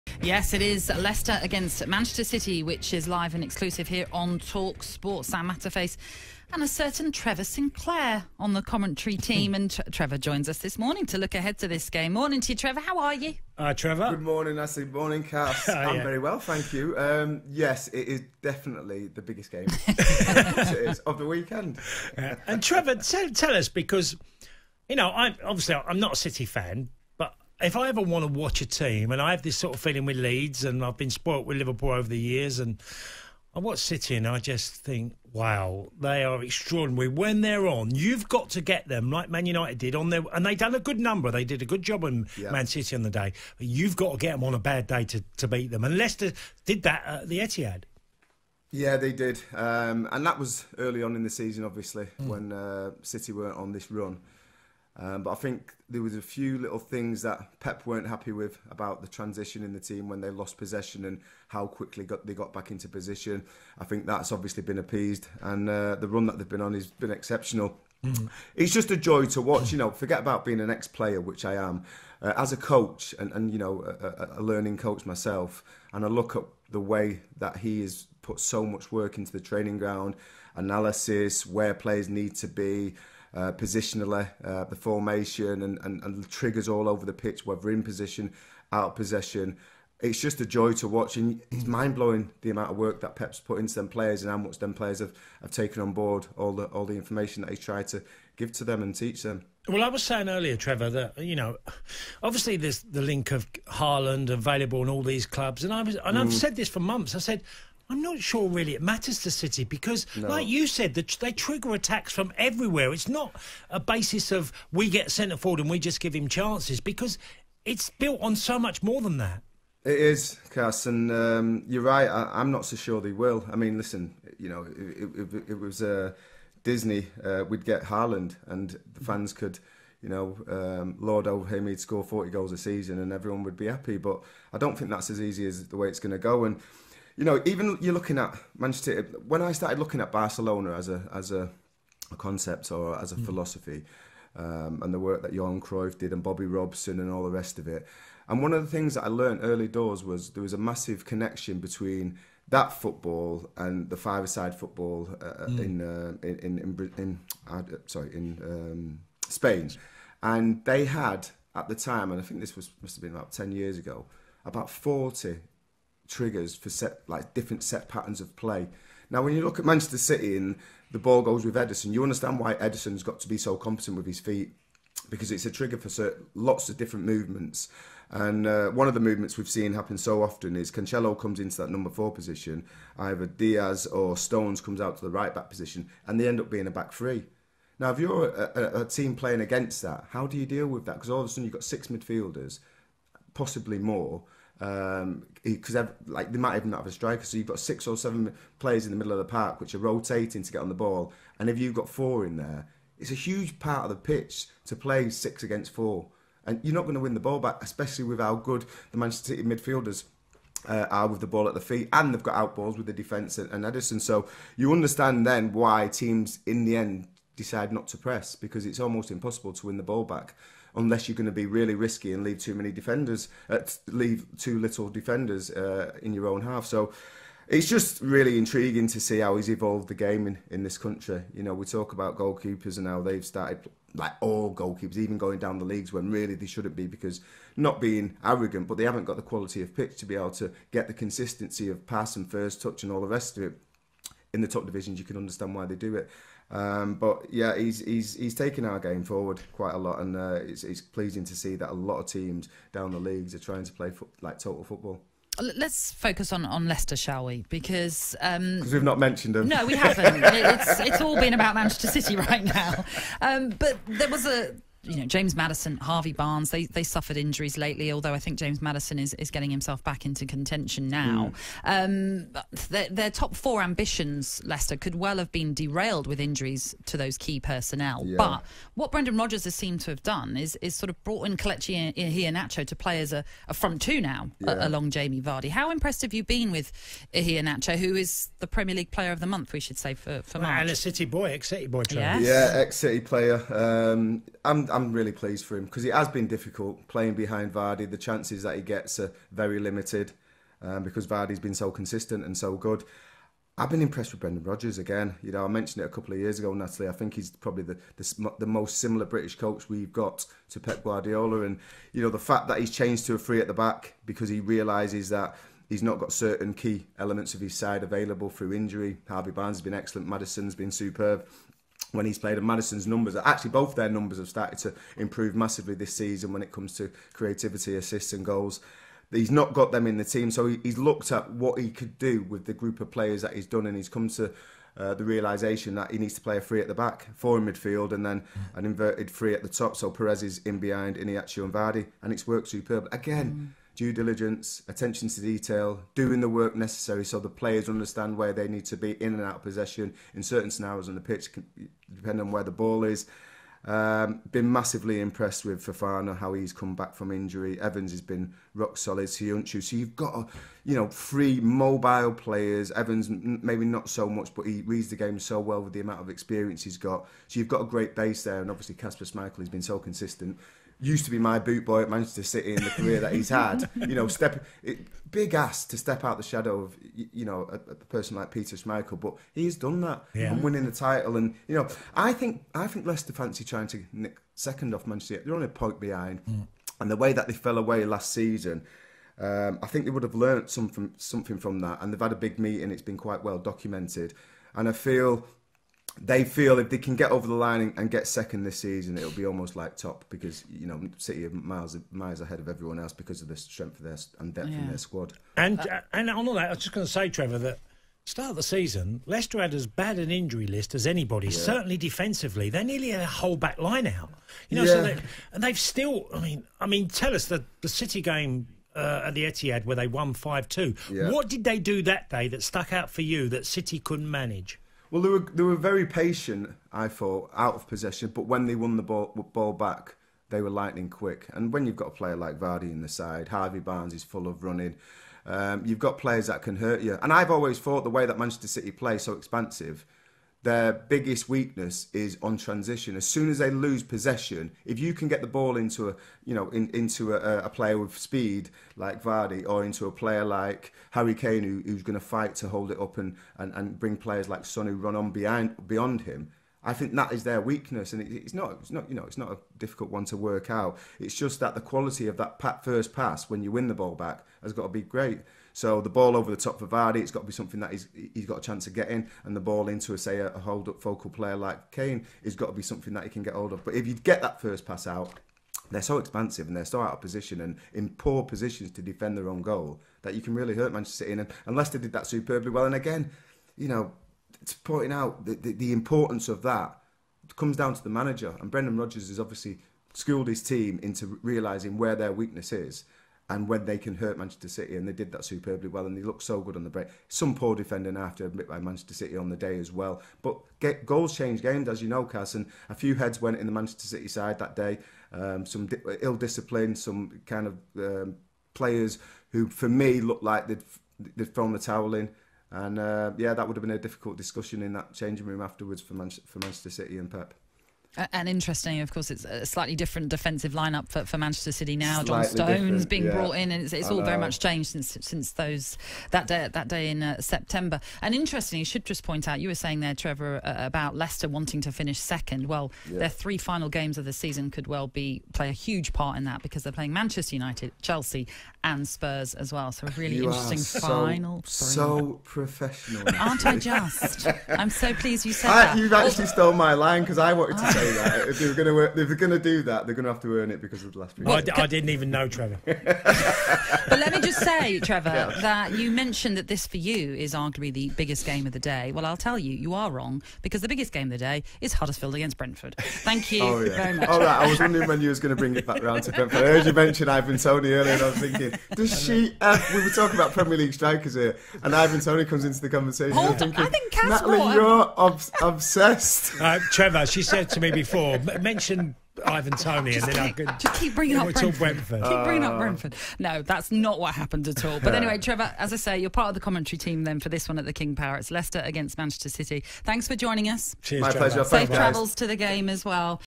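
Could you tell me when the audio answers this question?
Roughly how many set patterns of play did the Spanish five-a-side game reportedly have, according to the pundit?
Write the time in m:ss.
2:44.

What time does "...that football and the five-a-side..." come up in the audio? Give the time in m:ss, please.
2:32.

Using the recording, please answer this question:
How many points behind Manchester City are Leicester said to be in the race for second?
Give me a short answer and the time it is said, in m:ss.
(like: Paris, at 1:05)
1, at 6:25.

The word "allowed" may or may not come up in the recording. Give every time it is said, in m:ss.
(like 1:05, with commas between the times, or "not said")
not said.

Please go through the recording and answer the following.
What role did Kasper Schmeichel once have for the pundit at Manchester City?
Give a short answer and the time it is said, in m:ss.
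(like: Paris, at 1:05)
boot boy, at 6:11.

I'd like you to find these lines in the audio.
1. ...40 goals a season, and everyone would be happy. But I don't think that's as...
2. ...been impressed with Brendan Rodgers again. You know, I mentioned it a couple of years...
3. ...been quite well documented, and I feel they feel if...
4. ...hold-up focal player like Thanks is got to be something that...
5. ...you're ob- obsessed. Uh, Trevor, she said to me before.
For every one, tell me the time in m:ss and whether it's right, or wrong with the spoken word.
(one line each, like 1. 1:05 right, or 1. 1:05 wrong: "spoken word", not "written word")
1. 2:12 right
2. 5:03 right
3. 6:32 right
4. 7:50 wrong: "Kane", not "Thanks"
5. 9:34 right.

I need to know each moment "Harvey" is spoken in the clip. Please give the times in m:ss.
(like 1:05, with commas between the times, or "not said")
4:25, 5:19, 7:13.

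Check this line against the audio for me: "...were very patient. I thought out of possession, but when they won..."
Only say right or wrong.
right.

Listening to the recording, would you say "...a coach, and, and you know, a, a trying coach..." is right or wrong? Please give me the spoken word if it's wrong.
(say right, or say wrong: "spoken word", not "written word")
wrong: "learning", not "trying".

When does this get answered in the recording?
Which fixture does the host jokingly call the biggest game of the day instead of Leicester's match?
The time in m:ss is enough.
9:21.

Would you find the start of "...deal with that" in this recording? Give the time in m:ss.
3:10.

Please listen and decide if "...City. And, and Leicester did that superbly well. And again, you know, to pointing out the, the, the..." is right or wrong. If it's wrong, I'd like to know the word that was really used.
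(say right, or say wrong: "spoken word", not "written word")
right.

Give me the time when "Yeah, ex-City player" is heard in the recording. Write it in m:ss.
4:52.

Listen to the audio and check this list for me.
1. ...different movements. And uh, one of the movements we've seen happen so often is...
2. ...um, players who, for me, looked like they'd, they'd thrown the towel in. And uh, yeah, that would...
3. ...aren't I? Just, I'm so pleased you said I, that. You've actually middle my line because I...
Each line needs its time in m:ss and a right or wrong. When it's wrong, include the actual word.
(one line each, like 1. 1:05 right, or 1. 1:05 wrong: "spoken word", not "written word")
1. 2:56 right
2. 8:27 right
3. 9:03 wrong: "stole", not "middle".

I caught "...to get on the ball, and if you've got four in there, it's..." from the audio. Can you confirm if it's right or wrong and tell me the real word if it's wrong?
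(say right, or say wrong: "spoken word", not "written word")
right.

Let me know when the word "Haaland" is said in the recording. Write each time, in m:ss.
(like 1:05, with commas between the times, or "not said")
1:43, 2:07.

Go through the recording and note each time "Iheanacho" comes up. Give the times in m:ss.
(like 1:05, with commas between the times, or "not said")
4:41, 5:40.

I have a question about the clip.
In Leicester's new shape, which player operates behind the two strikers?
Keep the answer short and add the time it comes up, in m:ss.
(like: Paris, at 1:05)
Perez, at 5:39.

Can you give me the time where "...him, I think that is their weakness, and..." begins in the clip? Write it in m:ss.
7:36.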